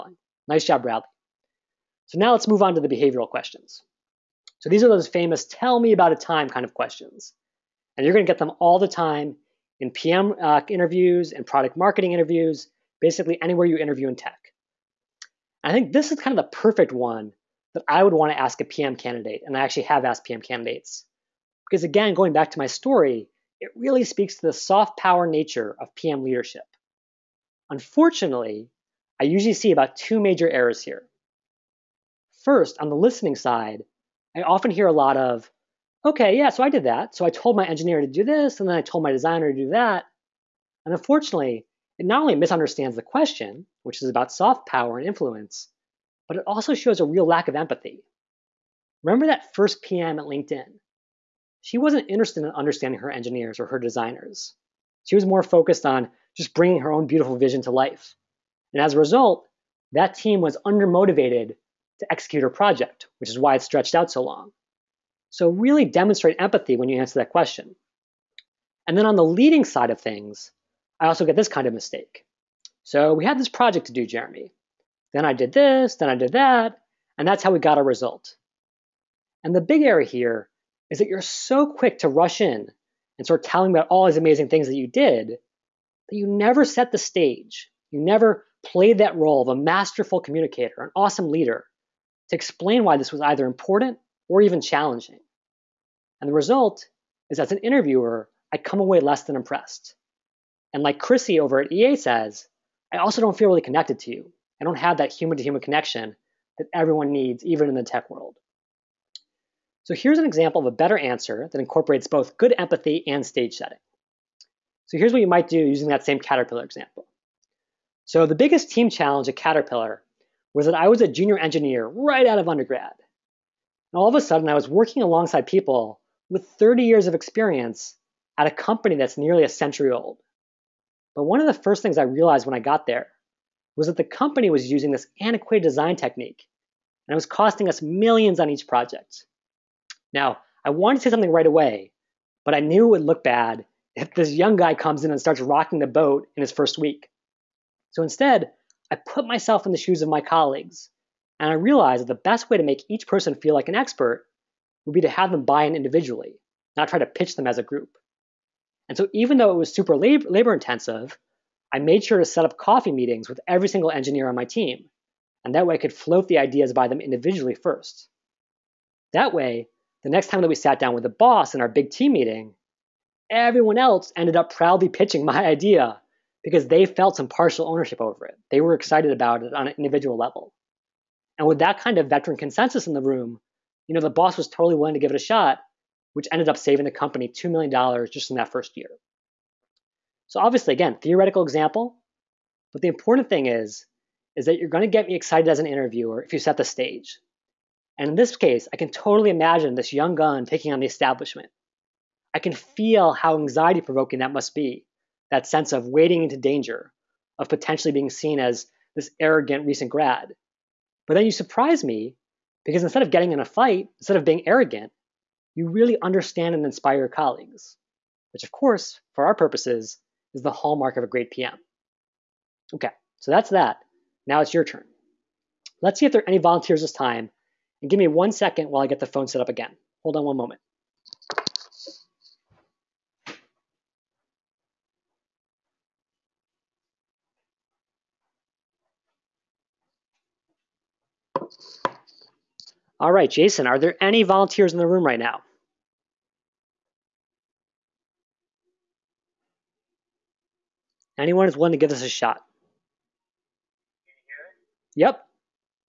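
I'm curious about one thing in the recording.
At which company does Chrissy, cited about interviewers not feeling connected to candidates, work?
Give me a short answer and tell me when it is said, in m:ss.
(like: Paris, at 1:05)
EA, at 1:41.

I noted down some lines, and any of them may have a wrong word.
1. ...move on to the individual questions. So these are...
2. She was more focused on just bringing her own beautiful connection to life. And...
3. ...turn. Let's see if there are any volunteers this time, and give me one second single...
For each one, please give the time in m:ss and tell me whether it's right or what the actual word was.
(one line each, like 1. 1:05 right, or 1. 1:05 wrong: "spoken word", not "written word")
1. 0:02 wrong: "behavioral", not "individual"
2. 0:55 wrong: "vision", not "connection"
3. 3:44 wrong: "while", not "single".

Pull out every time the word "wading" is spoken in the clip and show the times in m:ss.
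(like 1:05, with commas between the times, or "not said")
3:25.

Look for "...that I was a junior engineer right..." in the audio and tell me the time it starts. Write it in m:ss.
2:00.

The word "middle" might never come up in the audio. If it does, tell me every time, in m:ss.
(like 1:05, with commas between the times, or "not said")
not said.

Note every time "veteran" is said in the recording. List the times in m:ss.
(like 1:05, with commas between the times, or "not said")
3:02.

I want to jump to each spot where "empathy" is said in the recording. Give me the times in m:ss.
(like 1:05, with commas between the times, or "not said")
0:47, 1:06, 1:52.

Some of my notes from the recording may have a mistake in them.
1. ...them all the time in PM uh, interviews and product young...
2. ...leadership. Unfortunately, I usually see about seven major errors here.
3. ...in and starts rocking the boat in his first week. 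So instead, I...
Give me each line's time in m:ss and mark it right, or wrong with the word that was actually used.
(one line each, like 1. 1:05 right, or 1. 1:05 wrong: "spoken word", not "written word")
1. 0:08 wrong: "marketing", not "young"
2. 0:26 wrong: "two", not "seven"
3. 2:25 right.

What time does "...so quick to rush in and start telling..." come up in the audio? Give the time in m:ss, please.
1:21.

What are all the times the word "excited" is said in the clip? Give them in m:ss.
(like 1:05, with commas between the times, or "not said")
2:58, 3:15.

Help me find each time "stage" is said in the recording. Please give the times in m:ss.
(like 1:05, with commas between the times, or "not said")
1:26, 1:53, 3:16.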